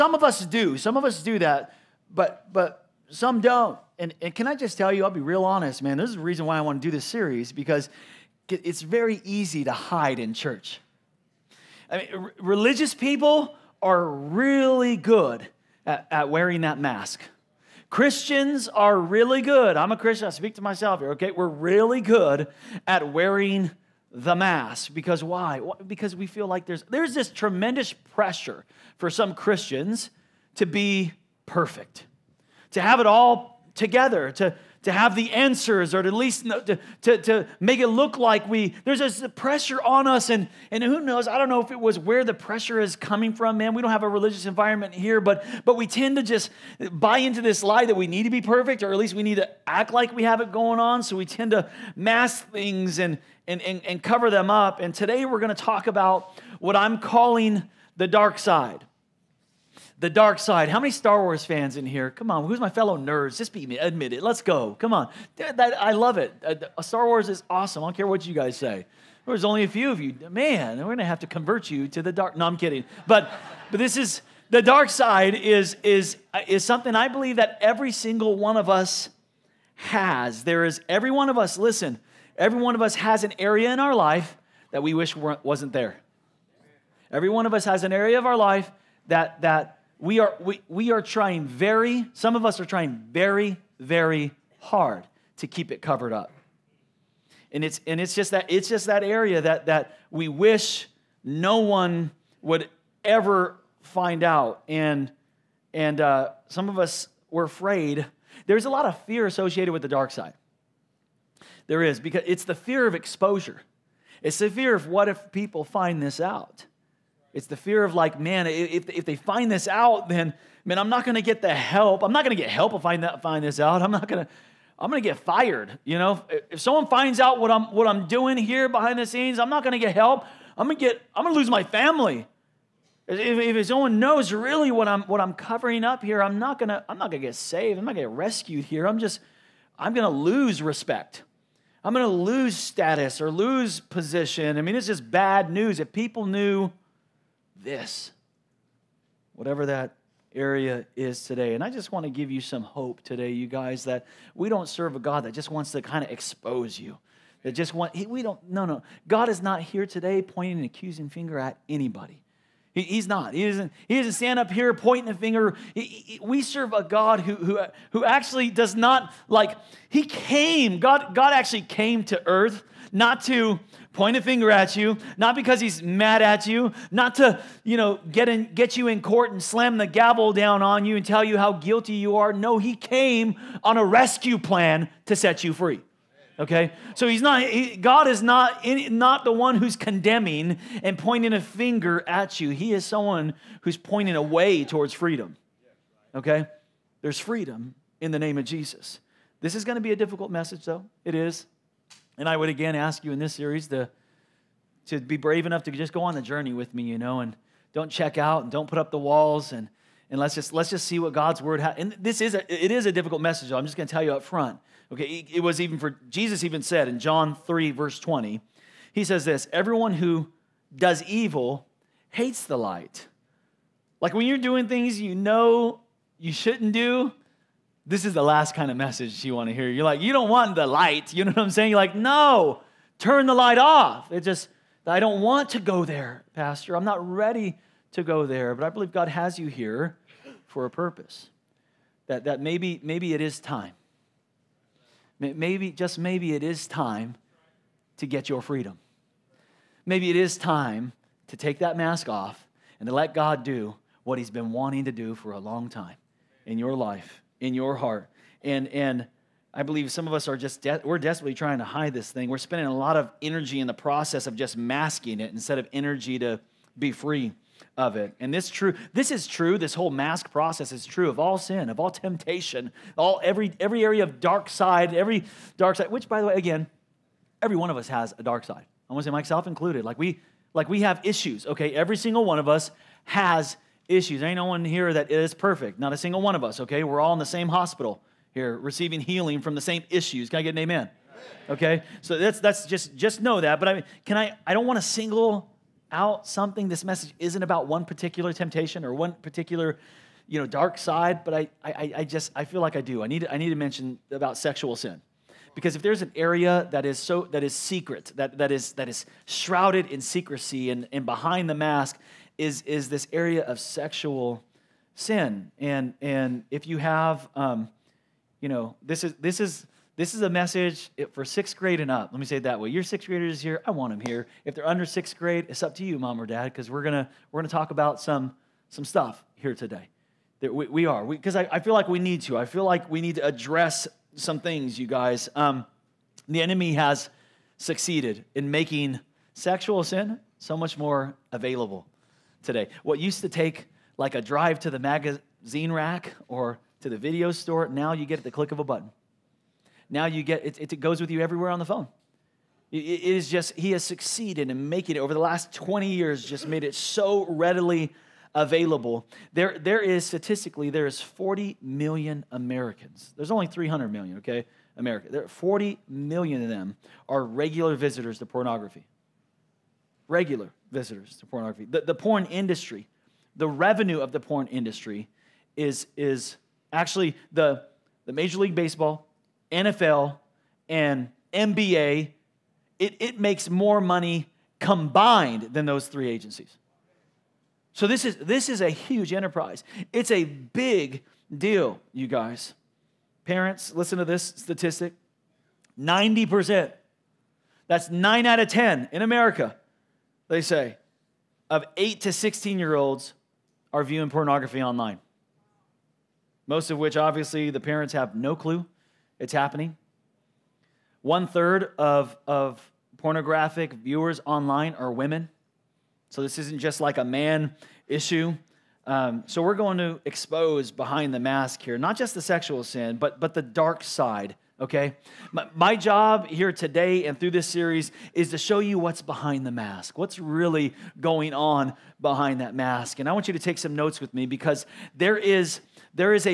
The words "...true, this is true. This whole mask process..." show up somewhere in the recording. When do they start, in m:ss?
4:28.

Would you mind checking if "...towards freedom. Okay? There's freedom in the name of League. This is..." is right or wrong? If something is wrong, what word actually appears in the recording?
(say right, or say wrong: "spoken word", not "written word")
wrong: "Jesus", not "League".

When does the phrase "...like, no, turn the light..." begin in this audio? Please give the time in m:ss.
3:51.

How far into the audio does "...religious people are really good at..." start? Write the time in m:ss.
0:12.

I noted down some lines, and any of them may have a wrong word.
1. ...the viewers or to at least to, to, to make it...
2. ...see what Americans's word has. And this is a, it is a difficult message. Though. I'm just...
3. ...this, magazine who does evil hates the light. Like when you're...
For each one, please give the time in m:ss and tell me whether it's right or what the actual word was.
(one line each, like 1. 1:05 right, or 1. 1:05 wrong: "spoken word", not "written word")
1. 0:35 wrong: "answers", not "viewers"
2. 3:30 wrong: "God", not "Americans"
3. 3:39 wrong: "everyone", not "magazine".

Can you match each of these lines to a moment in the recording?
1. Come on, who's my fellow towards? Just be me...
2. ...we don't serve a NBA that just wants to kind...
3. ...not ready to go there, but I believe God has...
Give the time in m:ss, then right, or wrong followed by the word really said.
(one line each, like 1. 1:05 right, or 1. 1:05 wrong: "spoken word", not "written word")
1. 1:02 wrong: "nerds", not "towards"
2. 2:34 wrong: "God", not "NBA"
3. 3:56 right.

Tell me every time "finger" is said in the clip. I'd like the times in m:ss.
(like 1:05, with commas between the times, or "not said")
2:41, 2:45, 2:54, 3:11.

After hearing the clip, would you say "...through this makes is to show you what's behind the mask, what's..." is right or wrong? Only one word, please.
wrong.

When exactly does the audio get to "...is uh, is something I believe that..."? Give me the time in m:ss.
1:15.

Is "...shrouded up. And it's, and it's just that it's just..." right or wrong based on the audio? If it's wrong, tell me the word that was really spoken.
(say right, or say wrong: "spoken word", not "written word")
wrong: "covered", not "shrouded".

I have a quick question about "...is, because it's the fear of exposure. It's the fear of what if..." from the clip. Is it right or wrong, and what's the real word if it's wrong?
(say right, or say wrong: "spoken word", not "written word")
right.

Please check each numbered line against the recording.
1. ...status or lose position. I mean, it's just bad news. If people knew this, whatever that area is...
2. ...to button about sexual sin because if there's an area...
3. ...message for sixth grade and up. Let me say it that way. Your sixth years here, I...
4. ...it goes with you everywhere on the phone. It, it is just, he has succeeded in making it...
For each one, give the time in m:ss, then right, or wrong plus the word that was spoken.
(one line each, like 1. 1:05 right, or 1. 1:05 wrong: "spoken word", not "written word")
1. 2:22 right
2. 5:03 wrong: "mention", not "button"
3. 5:20 wrong: "graders", not "years"
4. 5:50 right.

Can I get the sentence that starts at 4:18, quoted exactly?
And, and I believe some of us are just, de- we're desperately trying to hide this thing.